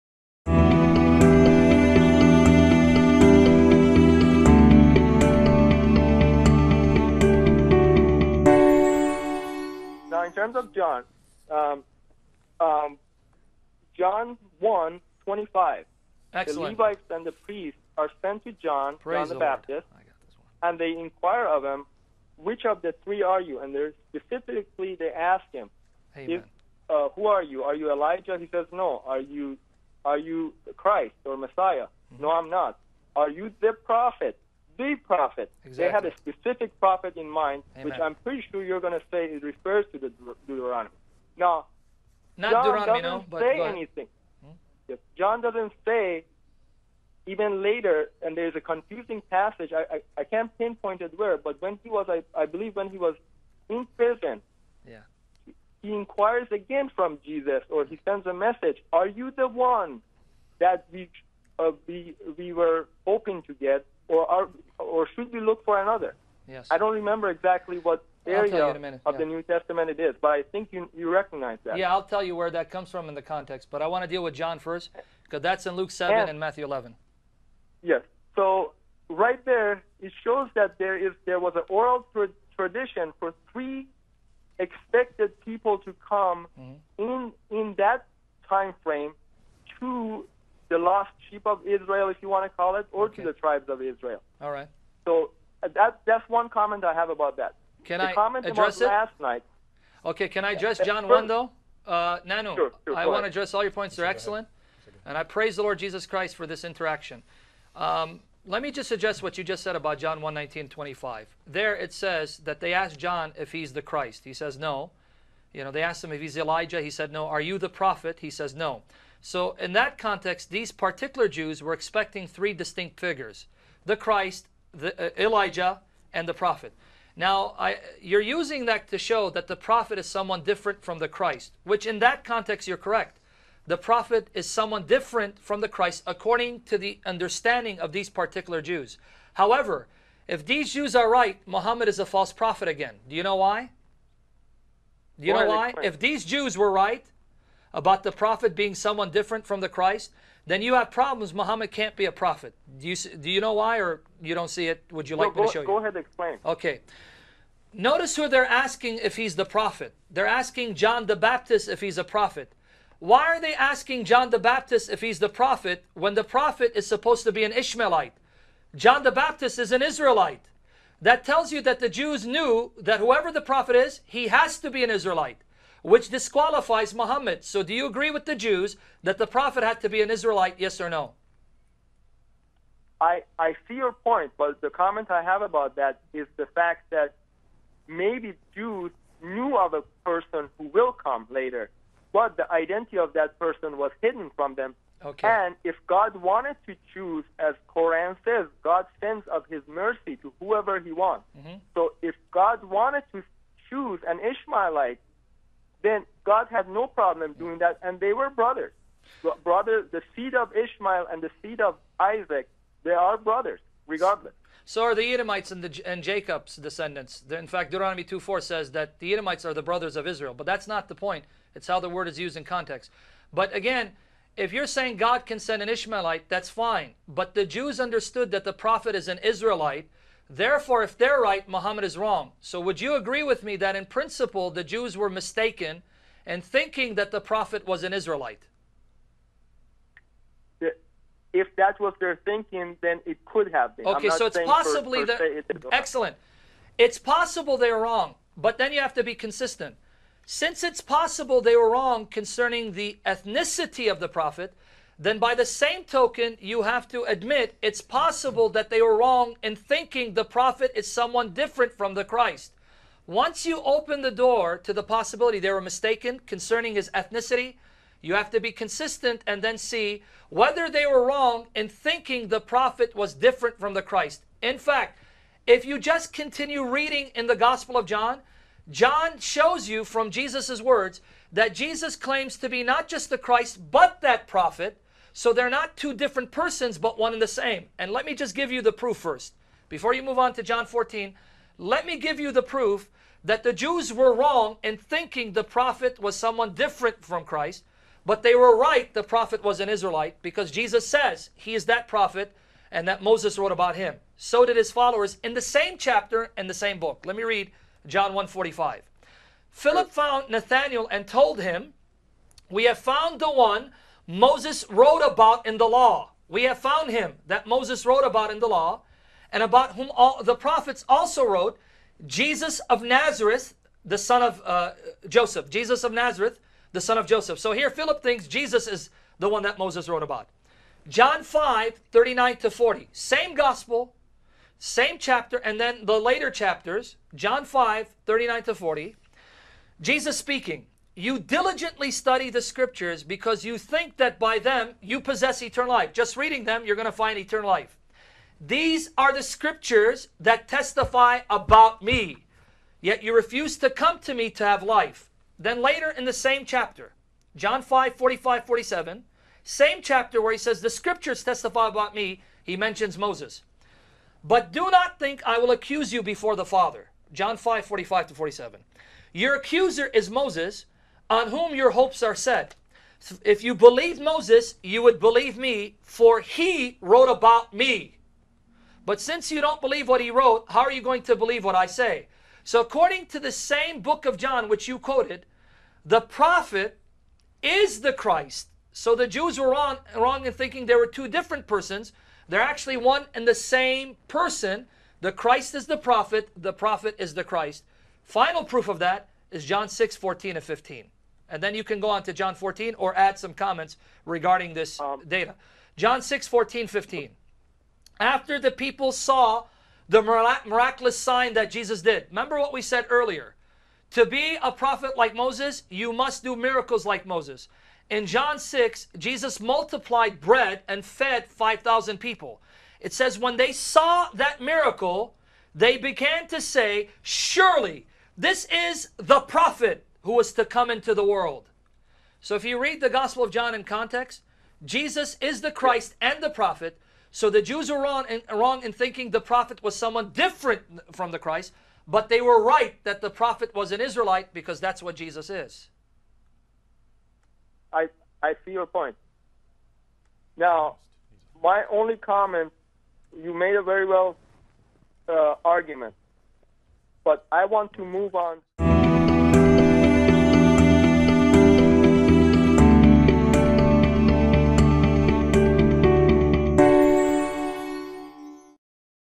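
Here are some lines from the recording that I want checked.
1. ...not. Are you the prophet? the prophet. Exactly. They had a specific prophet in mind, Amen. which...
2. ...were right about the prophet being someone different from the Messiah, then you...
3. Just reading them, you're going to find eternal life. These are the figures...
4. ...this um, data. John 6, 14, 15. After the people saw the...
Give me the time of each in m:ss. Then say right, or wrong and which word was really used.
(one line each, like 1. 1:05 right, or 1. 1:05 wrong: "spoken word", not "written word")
1. 0:32 right
2. 2:26 wrong: "Christ", not "Messiah"
3. 5:45 wrong: "scriptures", not "figures"
4. 6:44 right.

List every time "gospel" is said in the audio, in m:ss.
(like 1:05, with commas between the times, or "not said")
4:37, 5:33, 7:12.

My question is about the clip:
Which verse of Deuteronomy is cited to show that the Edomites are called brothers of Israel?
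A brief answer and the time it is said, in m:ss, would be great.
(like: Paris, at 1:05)
Deuteronomy 2:4, at 3:37.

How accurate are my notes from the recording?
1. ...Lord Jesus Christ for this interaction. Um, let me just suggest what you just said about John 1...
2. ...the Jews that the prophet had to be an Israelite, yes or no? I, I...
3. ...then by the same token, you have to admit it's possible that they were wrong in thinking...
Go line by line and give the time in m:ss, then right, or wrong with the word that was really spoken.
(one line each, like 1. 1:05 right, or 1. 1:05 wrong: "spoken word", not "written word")
1. 1:45 right
2. 2:58 right
3. 4:14 right.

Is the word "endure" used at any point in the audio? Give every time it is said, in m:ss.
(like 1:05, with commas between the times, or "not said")
not said.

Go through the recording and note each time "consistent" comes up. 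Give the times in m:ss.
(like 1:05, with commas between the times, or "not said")
4:09, 4:28.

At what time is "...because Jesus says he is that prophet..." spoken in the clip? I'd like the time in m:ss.
5:00.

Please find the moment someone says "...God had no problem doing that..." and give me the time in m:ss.
3:26.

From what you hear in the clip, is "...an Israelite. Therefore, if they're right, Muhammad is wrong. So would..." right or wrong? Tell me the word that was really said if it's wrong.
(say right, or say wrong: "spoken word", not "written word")
right.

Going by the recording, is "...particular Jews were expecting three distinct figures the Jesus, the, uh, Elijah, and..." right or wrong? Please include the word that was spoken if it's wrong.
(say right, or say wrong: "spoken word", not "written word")
wrong: "Christ", not "Jesus".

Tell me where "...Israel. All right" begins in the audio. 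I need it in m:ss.
1:33.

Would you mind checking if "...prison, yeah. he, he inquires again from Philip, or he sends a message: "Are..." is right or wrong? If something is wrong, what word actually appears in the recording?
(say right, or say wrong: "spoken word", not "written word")
wrong: "Jesus", not "Philip".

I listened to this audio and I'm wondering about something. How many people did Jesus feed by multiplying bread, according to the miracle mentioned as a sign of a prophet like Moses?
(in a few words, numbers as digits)
5000.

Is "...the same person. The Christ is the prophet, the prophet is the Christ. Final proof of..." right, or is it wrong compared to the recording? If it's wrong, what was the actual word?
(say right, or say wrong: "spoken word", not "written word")
right.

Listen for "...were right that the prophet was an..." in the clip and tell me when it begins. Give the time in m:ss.
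7:22.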